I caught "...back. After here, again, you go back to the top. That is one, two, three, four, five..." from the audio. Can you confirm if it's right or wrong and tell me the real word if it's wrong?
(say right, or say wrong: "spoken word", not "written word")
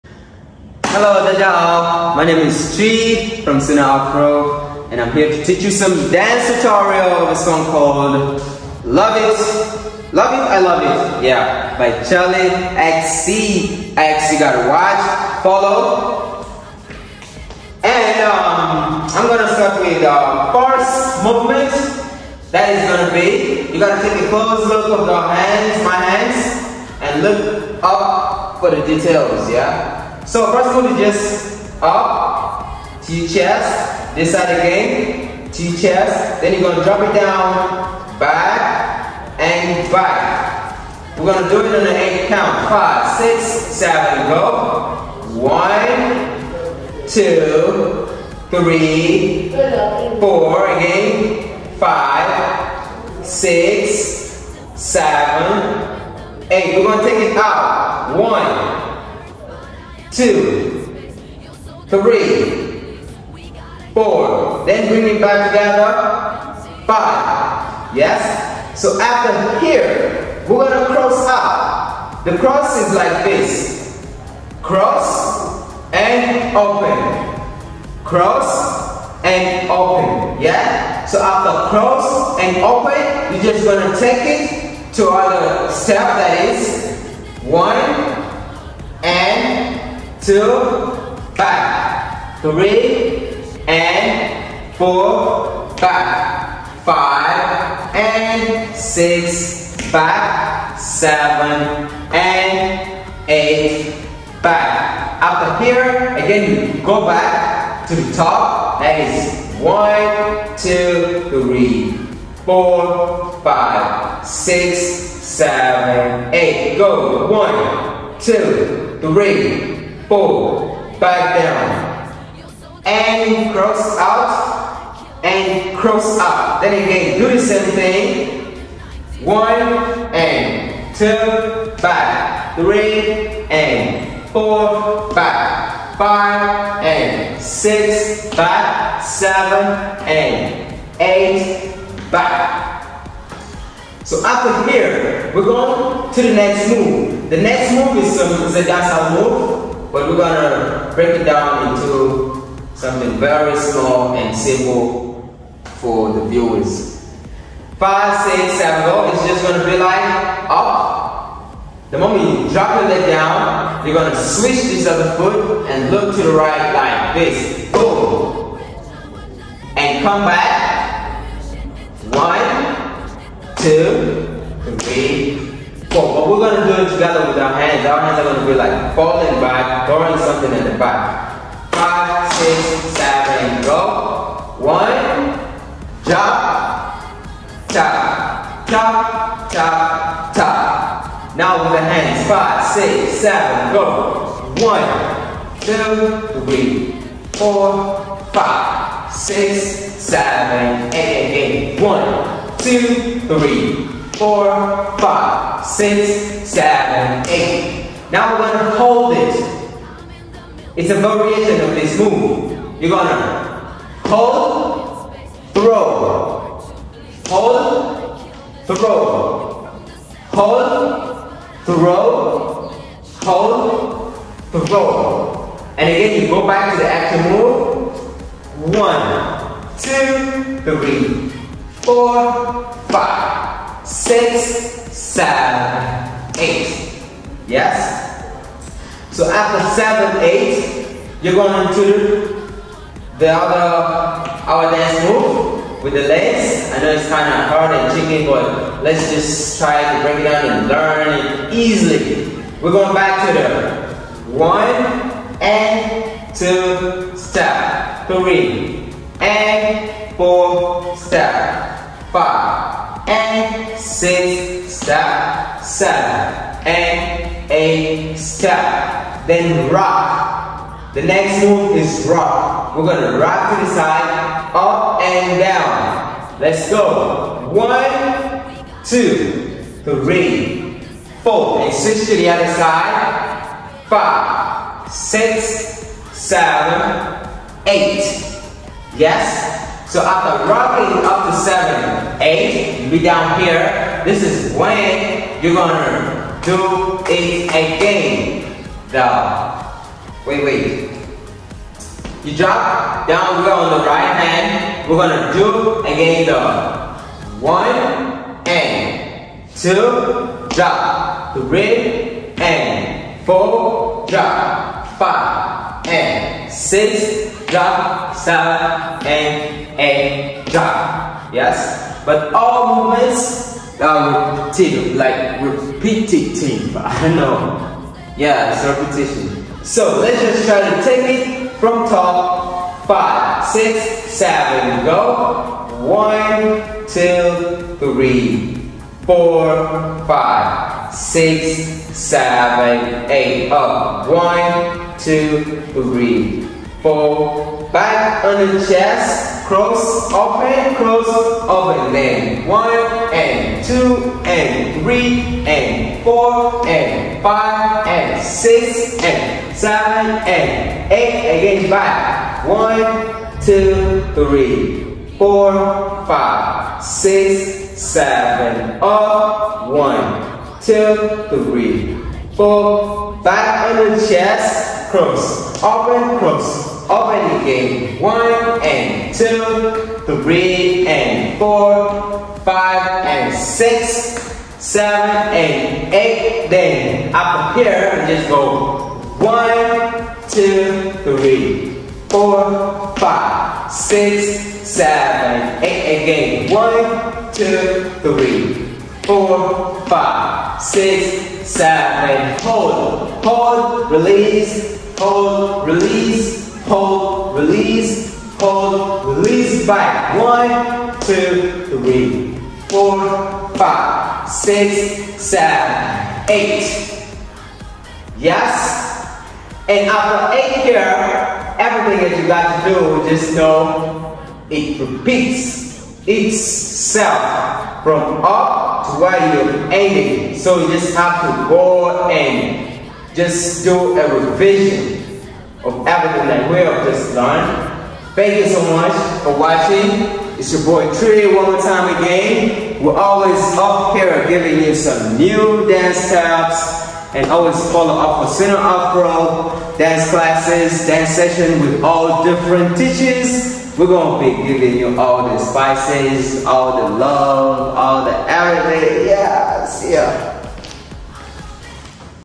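right.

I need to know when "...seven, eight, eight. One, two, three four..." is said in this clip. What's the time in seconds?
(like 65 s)
199 s.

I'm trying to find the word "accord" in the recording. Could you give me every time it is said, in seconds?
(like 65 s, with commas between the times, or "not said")
not said.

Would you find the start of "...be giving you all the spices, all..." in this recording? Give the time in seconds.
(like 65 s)
454 s.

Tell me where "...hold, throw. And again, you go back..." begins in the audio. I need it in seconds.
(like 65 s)
223 s.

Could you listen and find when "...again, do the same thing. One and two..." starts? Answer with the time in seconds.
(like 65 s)
126 s.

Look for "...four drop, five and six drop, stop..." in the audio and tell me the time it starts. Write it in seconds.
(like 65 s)
313 s.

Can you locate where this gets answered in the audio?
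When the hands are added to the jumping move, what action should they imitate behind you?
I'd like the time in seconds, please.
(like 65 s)
179 s.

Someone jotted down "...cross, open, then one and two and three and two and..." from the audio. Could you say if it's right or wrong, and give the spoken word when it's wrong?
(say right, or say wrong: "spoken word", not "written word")
wrong: "four", not "two".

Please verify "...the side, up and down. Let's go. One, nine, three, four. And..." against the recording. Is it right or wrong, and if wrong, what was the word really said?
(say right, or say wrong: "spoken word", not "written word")
wrong: "two", not "nine".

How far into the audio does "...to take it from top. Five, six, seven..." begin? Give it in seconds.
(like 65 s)
330 s.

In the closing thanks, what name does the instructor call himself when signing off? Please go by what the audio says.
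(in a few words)
Trey.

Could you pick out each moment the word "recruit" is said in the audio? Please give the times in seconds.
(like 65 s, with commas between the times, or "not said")
not said.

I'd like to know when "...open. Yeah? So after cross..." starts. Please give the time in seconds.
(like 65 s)
79 s.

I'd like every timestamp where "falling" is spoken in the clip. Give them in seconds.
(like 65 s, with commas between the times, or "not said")
178 s.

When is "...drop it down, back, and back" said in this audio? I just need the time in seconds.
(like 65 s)
36 s.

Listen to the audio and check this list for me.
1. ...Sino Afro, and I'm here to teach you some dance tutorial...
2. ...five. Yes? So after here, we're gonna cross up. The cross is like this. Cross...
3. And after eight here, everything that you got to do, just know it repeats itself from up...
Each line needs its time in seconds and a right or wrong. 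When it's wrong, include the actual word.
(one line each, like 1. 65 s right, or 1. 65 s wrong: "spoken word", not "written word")
1. 3 s right
2. 66 s right
3. 419 s right.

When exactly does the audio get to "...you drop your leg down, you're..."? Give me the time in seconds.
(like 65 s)
162 s.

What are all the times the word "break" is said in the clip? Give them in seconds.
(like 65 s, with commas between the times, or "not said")
150 s, 250 s.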